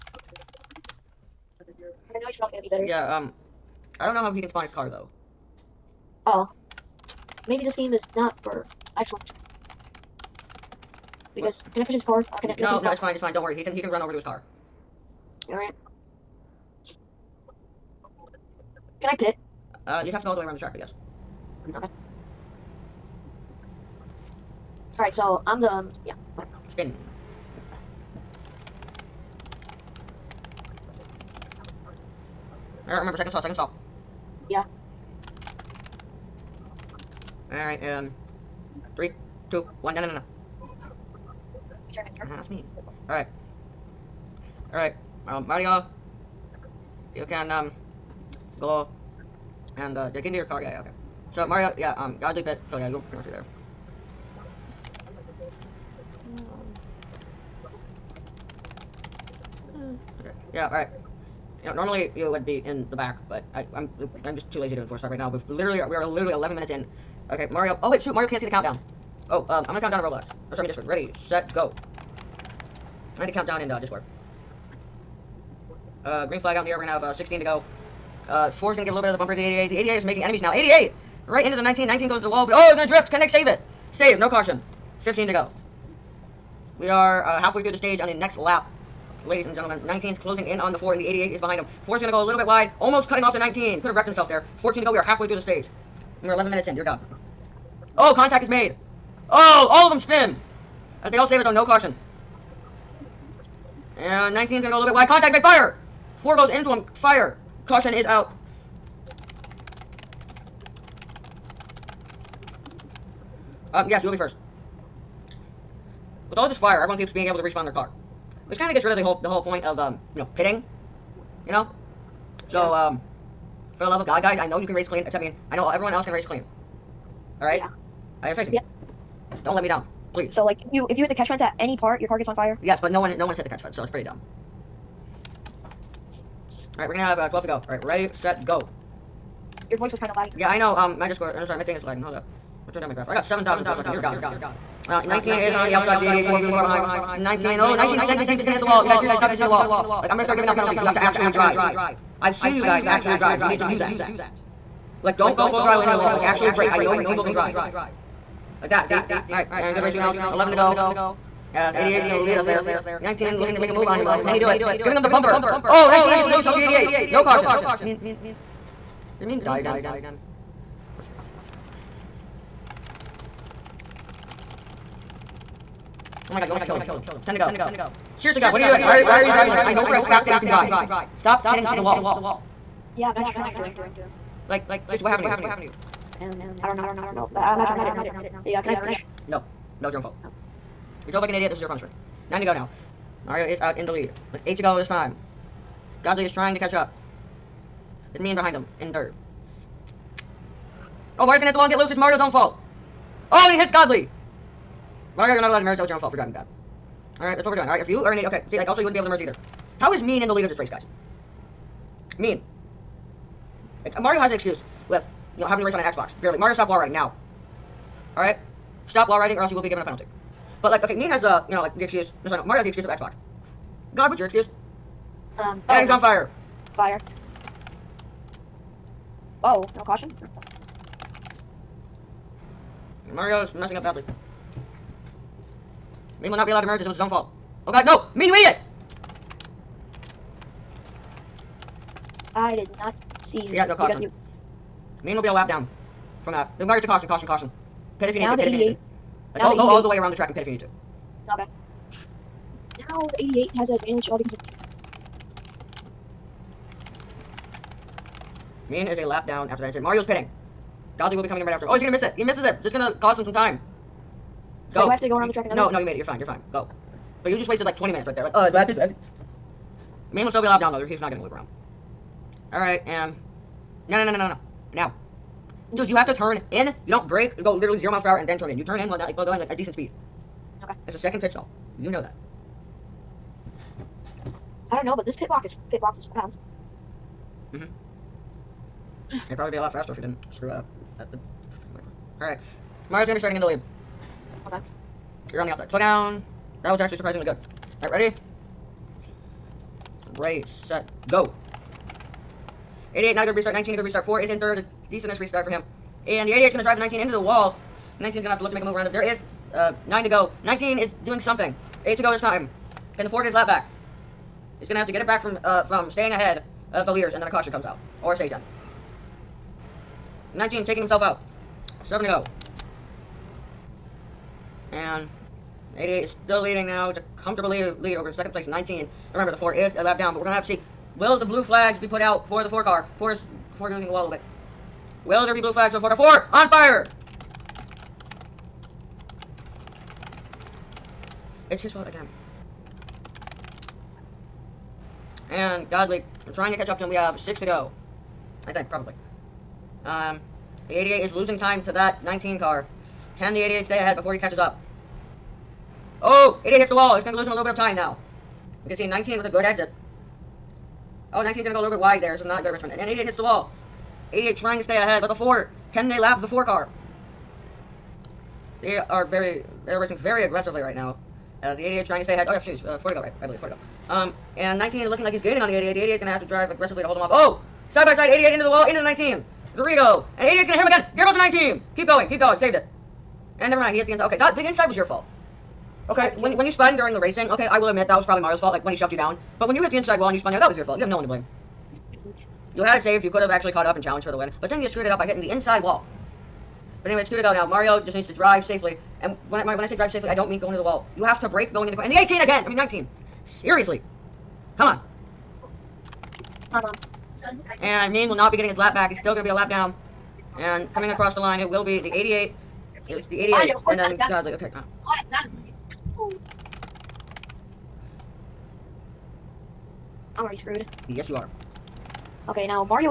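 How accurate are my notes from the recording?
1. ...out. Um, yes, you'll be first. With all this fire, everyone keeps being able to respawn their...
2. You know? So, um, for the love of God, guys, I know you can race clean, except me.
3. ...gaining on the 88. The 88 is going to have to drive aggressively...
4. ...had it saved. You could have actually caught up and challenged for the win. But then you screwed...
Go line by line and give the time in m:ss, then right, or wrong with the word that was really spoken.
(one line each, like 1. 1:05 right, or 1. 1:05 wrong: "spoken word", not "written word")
1. 1:48 right
2. 2:01 right
3. 6:15 right
4. 6:32 right.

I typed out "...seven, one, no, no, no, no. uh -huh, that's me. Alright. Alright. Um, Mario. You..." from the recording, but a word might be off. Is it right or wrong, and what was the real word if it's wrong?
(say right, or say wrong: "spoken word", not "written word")
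wrong: "two", not "seven".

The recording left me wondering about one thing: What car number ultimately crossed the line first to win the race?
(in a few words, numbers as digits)
88.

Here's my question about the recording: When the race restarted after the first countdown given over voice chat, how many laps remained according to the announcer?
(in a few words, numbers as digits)
16.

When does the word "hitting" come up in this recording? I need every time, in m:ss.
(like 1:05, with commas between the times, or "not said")
3:01, 6:35.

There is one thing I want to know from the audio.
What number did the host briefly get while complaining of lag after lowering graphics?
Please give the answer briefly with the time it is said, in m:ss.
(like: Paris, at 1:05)
7,000, at 2:23.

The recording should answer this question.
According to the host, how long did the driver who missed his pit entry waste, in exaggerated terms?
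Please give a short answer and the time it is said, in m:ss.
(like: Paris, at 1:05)
20 minutes, at 4:27.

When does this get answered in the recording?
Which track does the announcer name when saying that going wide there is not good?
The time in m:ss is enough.
6:02.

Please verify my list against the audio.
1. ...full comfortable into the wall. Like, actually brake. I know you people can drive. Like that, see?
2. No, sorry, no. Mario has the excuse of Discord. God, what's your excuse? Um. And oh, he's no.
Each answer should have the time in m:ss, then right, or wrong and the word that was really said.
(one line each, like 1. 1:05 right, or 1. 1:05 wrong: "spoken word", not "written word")
1. 2:35 wrong: "throttle", not "comfortable"
2. 3:42 wrong: "Xbox", not "Discord".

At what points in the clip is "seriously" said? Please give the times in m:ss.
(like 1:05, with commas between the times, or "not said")
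2:28, 2:58, 3:04, 6:43.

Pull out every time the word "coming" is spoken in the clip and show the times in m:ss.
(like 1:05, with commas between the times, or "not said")
4:21, 6:50.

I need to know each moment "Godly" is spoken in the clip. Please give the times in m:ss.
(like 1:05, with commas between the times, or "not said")
0:52, 3:16, 3:23, 5:45, 6:54.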